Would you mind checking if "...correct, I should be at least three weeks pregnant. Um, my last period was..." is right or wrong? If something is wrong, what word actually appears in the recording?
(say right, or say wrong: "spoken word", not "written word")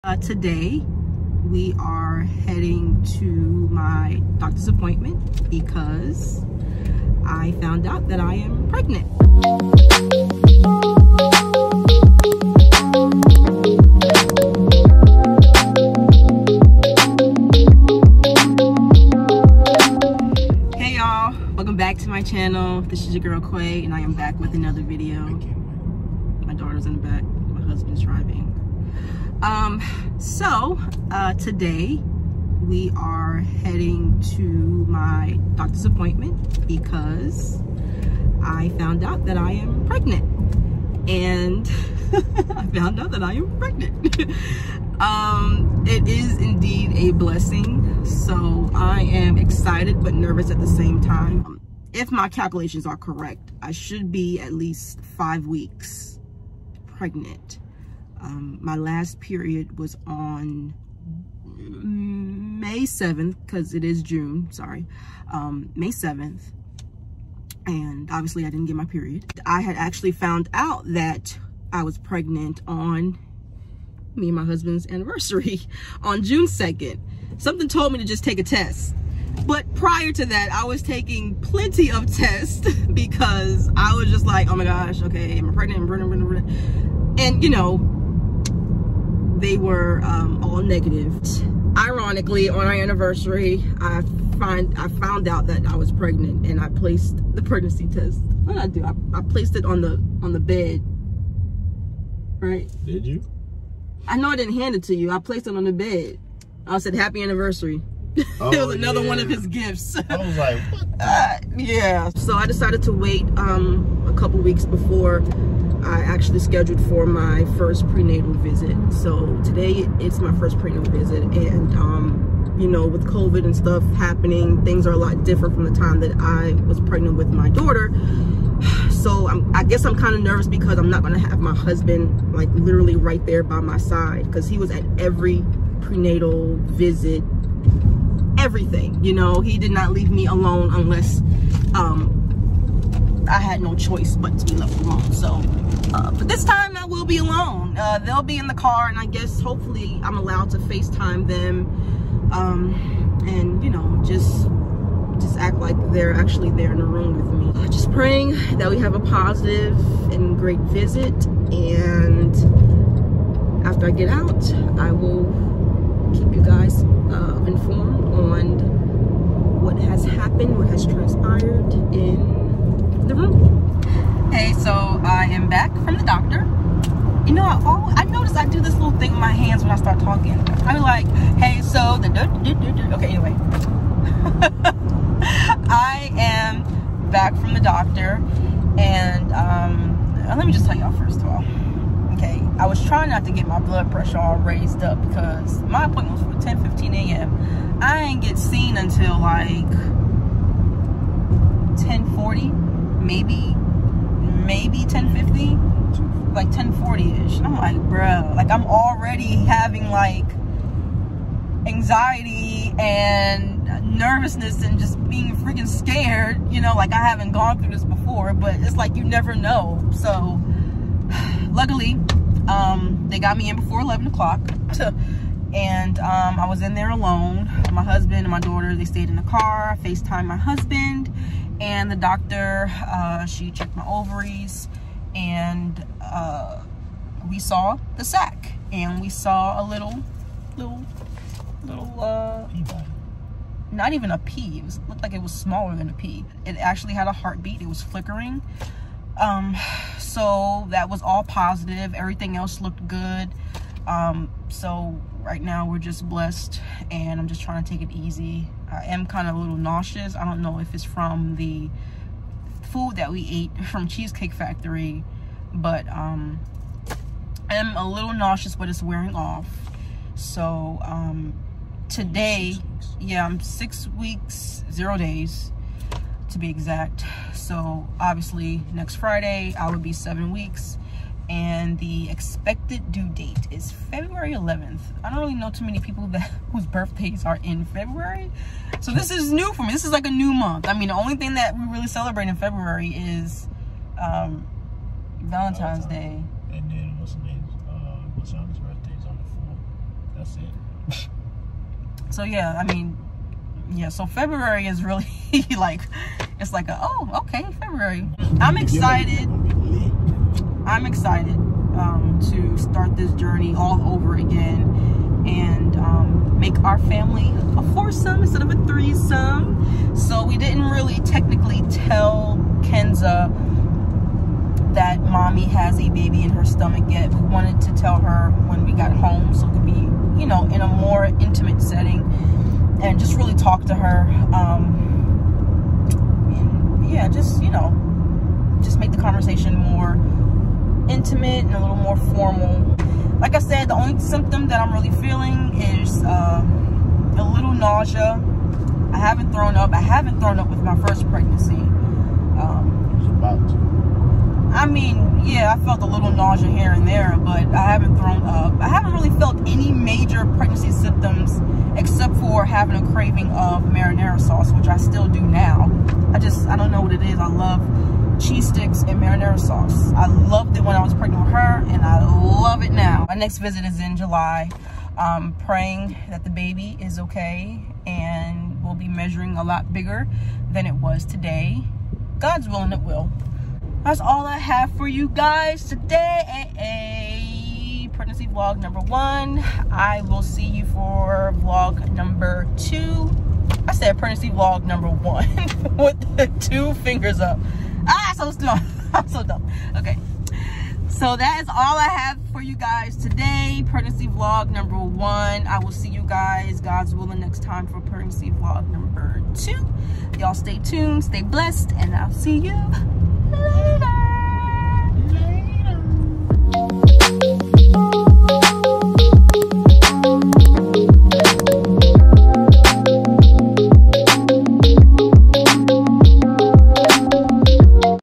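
wrong: "five", not "three".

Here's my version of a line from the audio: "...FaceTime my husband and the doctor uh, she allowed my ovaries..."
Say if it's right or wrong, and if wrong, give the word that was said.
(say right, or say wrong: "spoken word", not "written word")
wrong: "checked", not "allowed".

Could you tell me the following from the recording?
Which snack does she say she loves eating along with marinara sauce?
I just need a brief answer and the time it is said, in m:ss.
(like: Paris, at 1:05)
Cheese sticks, at 6:08.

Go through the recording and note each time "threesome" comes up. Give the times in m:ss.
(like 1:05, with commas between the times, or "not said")
5:18.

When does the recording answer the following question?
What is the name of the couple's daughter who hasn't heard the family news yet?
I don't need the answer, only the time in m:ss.
5:22.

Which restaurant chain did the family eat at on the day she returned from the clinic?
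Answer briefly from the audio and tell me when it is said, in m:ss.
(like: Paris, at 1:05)
Cheesecake Factory, at 4:23.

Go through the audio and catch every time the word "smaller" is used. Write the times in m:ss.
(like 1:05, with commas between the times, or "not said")
4:05.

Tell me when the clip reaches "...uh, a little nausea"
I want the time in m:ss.
5:46.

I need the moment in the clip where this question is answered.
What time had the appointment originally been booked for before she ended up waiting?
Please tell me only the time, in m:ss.
3:16.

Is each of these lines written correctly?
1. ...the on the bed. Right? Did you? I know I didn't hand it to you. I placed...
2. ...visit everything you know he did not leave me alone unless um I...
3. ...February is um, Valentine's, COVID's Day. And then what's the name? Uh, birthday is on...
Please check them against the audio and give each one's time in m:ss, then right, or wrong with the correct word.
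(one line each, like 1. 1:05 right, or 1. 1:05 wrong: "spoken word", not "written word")
1. 1:39 right
2. 2:16 right
3. 4:52 wrong: "Valentine", not "COVID".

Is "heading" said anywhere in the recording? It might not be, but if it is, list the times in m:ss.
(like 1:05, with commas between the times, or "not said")
0:02, 0:33.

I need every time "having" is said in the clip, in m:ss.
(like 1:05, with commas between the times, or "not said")
3:29, 6:02.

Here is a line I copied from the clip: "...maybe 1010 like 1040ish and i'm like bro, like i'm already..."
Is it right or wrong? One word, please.
wrong.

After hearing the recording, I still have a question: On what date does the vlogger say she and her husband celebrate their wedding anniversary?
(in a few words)
June 2nd.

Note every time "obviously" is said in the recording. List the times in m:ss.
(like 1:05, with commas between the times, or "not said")
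1:08, 4:37.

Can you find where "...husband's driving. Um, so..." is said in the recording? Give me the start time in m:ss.
0:27.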